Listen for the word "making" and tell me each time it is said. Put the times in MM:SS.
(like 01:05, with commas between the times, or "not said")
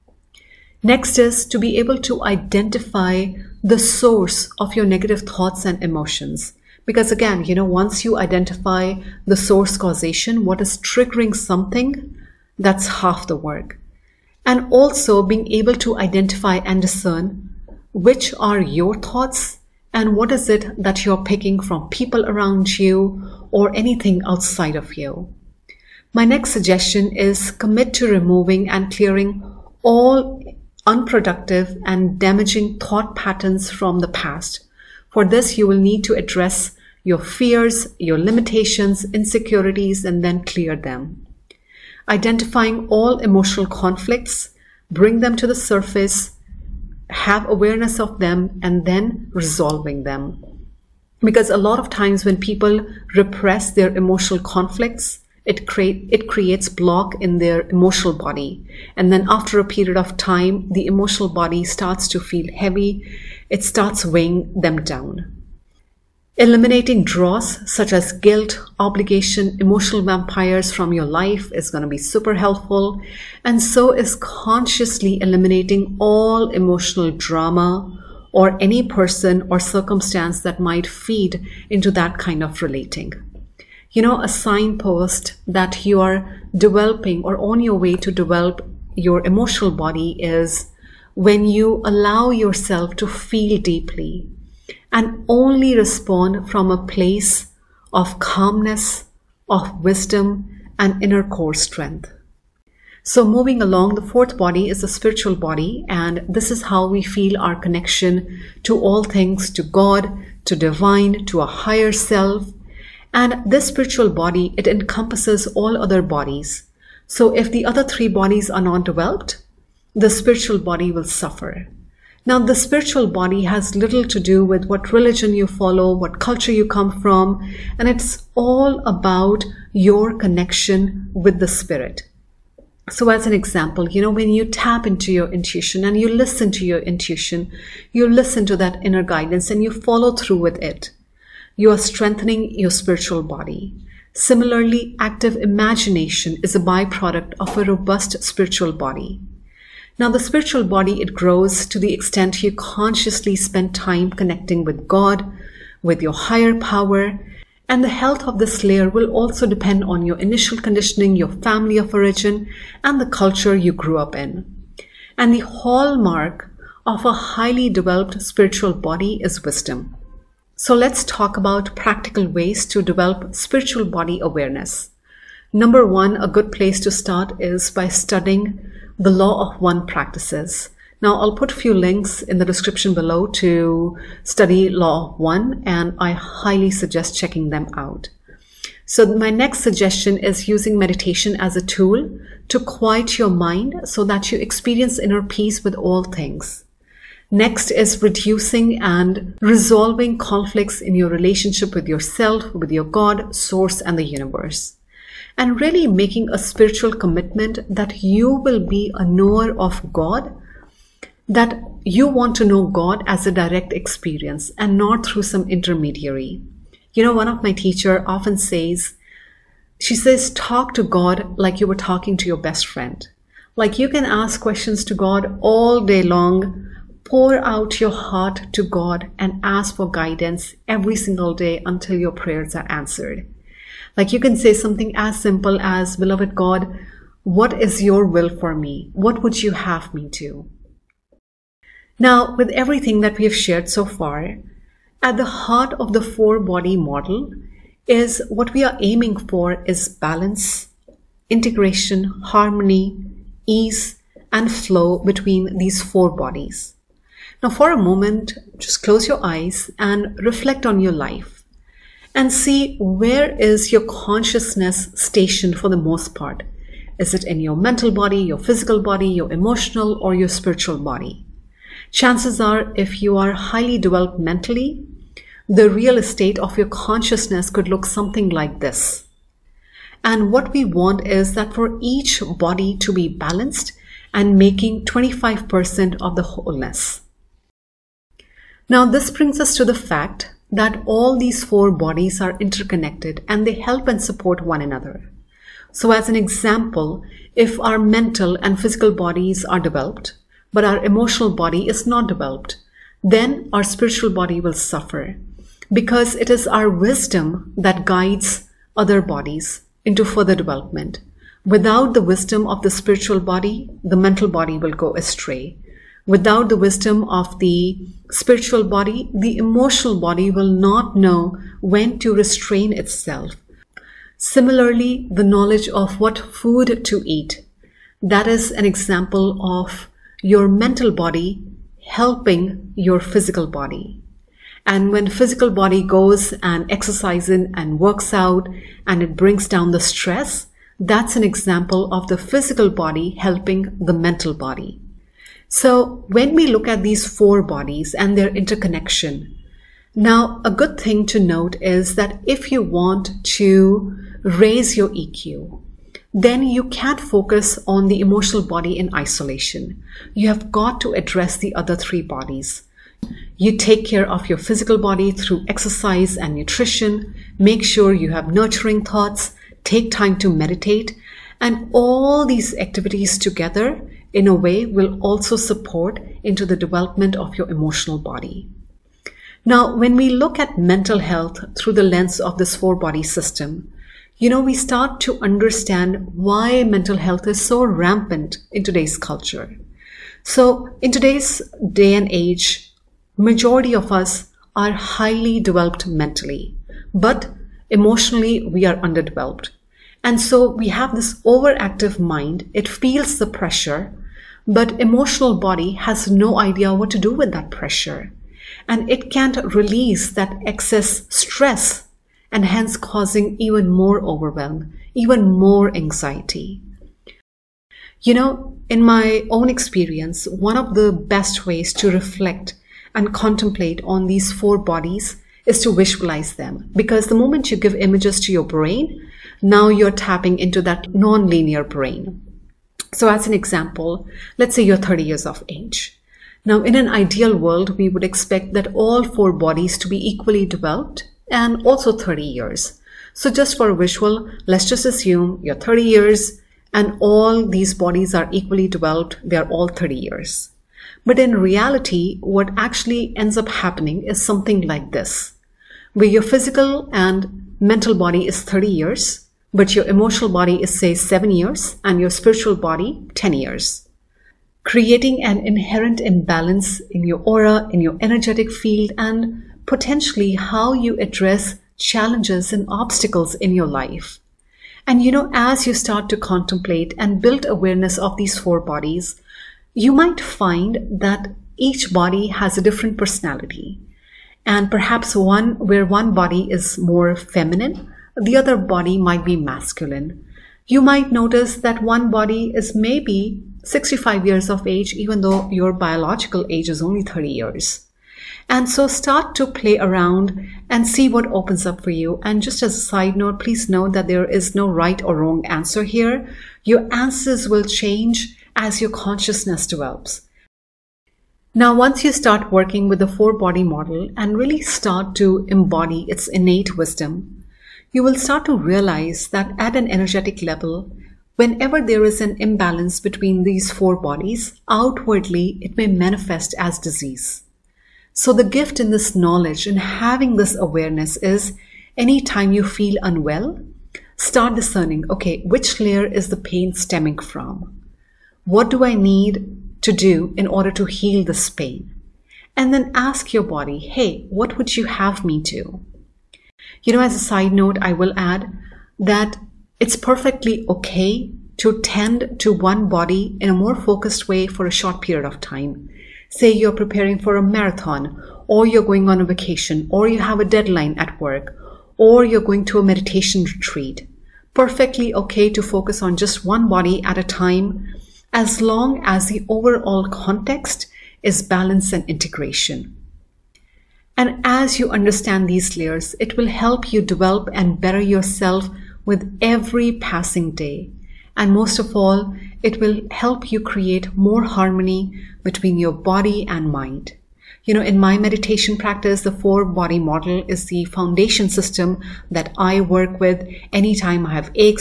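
03:25, 04:44.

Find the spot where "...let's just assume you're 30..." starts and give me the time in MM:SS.
07:24.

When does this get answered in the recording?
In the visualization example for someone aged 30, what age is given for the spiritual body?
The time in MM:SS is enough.
07:43.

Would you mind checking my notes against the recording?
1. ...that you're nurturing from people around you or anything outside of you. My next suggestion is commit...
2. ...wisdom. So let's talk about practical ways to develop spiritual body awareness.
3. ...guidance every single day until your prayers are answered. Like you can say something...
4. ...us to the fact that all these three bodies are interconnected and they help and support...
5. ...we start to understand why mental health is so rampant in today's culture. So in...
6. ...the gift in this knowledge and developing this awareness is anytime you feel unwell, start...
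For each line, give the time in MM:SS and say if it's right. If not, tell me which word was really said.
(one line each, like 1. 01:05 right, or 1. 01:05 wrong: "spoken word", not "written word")
1. 00:20 wrong: "picking", not "nurturing"
2. 02:49 right
3. 03:49 right
4. 04:49 wrong: "four", not "three"
5. 06:24 right
6. 08:48 wrong: "having", not "developing".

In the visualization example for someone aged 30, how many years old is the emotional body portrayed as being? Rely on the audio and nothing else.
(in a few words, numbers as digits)
7.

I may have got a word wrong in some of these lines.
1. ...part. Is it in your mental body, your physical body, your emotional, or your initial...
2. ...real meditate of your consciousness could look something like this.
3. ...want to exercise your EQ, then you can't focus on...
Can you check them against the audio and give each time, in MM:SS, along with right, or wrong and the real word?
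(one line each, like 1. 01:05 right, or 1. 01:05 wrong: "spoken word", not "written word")
1. 04:26 wrong: "spiritual", not "initial"
2. 04:35 wrong: "estate", not "meditate"
3. 05:52 wrong: "raise", not "exercise".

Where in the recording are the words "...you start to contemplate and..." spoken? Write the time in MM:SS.
07:55.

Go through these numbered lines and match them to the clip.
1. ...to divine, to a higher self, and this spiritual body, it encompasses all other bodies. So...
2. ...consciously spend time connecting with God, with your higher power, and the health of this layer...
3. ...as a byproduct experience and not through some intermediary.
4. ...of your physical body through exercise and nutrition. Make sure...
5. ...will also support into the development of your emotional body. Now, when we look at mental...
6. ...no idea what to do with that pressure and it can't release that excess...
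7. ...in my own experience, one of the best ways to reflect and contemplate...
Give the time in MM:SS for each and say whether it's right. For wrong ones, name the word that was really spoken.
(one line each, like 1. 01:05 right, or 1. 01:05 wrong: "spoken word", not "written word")
1. 01:50 right
2. 02:32 right
3. 03:33 wrong: "direct", not "byproduct"
4. 06:04 right
5. 06:14 right
6. 06:46 right
7. 06:58 right.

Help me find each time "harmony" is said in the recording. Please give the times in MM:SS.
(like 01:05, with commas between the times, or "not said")
04:12, 09:44.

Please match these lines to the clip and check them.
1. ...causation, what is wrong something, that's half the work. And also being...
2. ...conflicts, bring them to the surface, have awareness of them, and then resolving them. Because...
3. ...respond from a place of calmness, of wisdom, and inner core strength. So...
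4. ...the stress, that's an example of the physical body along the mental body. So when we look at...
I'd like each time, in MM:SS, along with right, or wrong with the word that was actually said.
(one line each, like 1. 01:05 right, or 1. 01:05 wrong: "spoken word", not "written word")
1. 00:09 wrong: "triggering", not "wrong"
2. 00:43 right
3. 01:35 right
4. 05:39 wrong: "helping", not "along".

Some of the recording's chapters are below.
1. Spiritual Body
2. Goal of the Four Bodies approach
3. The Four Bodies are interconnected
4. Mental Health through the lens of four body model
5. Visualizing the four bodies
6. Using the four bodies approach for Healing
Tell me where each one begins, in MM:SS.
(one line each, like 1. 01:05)
1. 01:35
2. 03:56
3. 04:47
4. 06:19
5. 06:56
6. 08:30.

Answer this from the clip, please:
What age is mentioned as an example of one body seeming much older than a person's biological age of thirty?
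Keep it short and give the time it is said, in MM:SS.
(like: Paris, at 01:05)
65, at 08:13.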